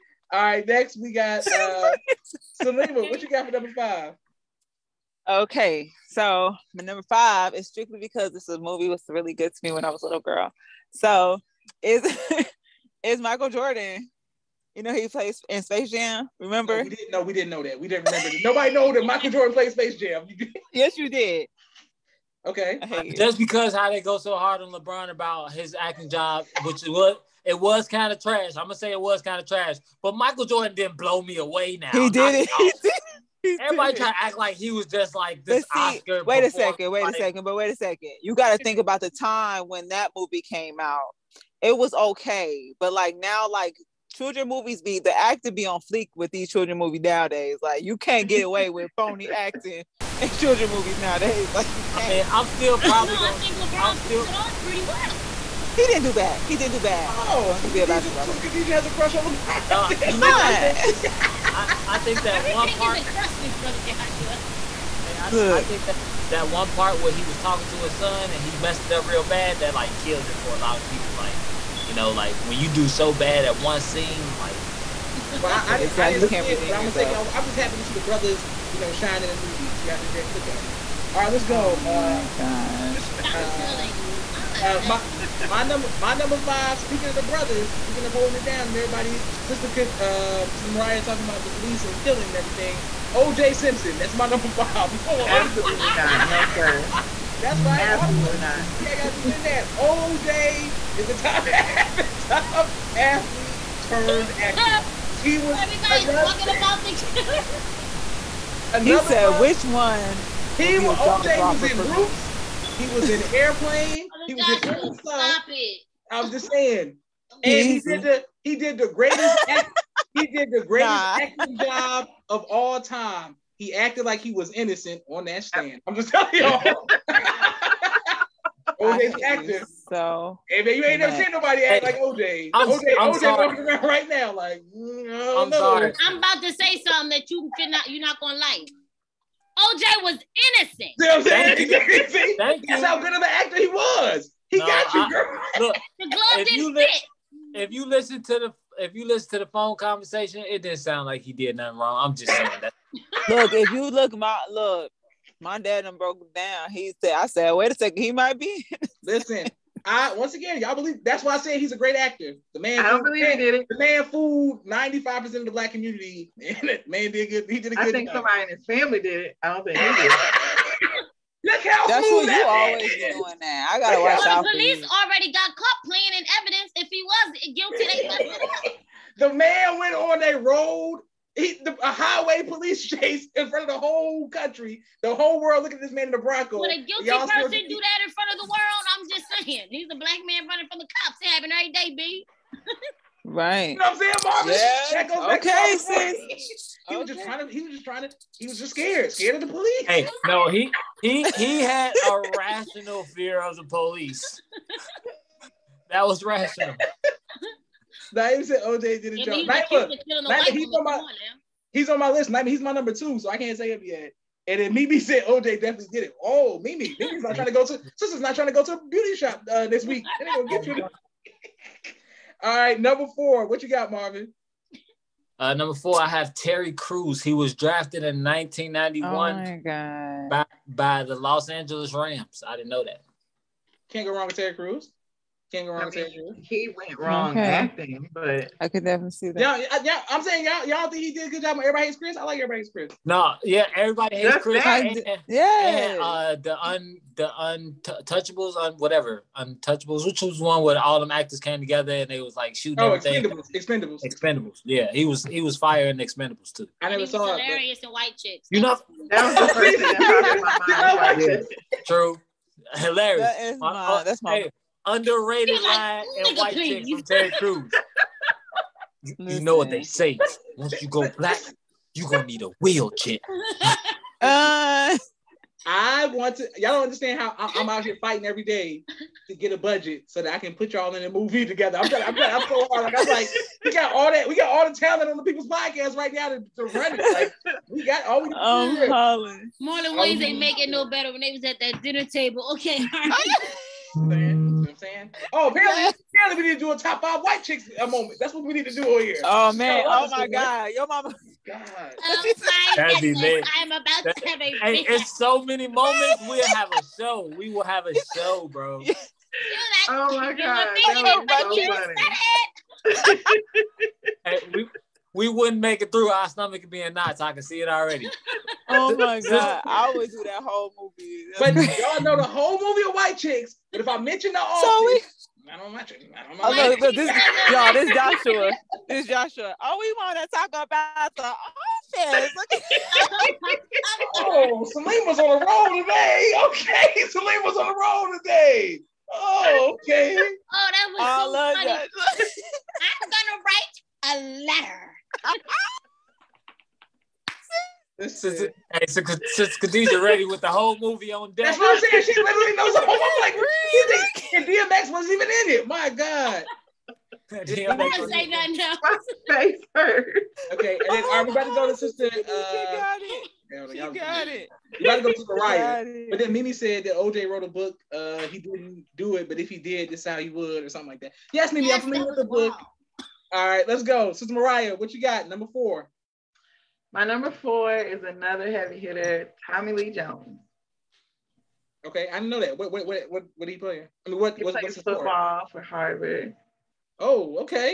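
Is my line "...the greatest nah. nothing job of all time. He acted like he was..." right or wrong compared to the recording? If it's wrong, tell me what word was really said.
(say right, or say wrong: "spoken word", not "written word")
wrong: "acting", not "nothing".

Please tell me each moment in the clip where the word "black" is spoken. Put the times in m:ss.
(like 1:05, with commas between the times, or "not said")
2:45, 3:09, 4:31.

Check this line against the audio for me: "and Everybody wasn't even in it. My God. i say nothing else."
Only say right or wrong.
wrong.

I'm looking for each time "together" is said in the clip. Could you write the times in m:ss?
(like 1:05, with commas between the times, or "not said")
4:11, 4:41.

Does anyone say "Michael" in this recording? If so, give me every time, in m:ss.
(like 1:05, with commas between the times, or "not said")
0:13, 0:19, 0:30.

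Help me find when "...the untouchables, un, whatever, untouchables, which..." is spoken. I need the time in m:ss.
4:07.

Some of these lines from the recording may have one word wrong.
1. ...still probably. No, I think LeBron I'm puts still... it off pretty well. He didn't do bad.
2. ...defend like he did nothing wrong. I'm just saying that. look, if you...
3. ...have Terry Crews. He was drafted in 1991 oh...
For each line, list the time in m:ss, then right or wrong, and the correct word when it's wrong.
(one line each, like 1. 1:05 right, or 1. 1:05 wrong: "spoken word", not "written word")
1. 0:52 right
2. 2:30 wrong: "sound", not "defend"
3. 3:46 right.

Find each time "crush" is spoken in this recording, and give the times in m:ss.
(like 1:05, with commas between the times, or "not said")
0:58, 1:03.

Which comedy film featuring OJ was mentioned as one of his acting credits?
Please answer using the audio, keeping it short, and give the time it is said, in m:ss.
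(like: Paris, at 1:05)
Airplane, at 1:53.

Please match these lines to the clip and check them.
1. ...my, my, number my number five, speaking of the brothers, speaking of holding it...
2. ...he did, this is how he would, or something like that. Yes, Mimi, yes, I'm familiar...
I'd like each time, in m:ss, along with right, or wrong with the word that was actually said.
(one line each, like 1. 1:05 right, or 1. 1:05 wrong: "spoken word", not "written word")
1. 1:24 right
2. 6:09 right.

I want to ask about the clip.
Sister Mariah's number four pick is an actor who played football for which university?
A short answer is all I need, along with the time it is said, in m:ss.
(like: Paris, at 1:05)
Harvard, at 6:25.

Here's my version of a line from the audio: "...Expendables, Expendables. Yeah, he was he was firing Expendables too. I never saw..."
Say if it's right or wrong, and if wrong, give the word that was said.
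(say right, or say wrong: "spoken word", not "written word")
right.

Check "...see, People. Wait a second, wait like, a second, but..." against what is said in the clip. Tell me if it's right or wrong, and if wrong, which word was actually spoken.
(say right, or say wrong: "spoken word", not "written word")
wrong: "Oscar", not "People".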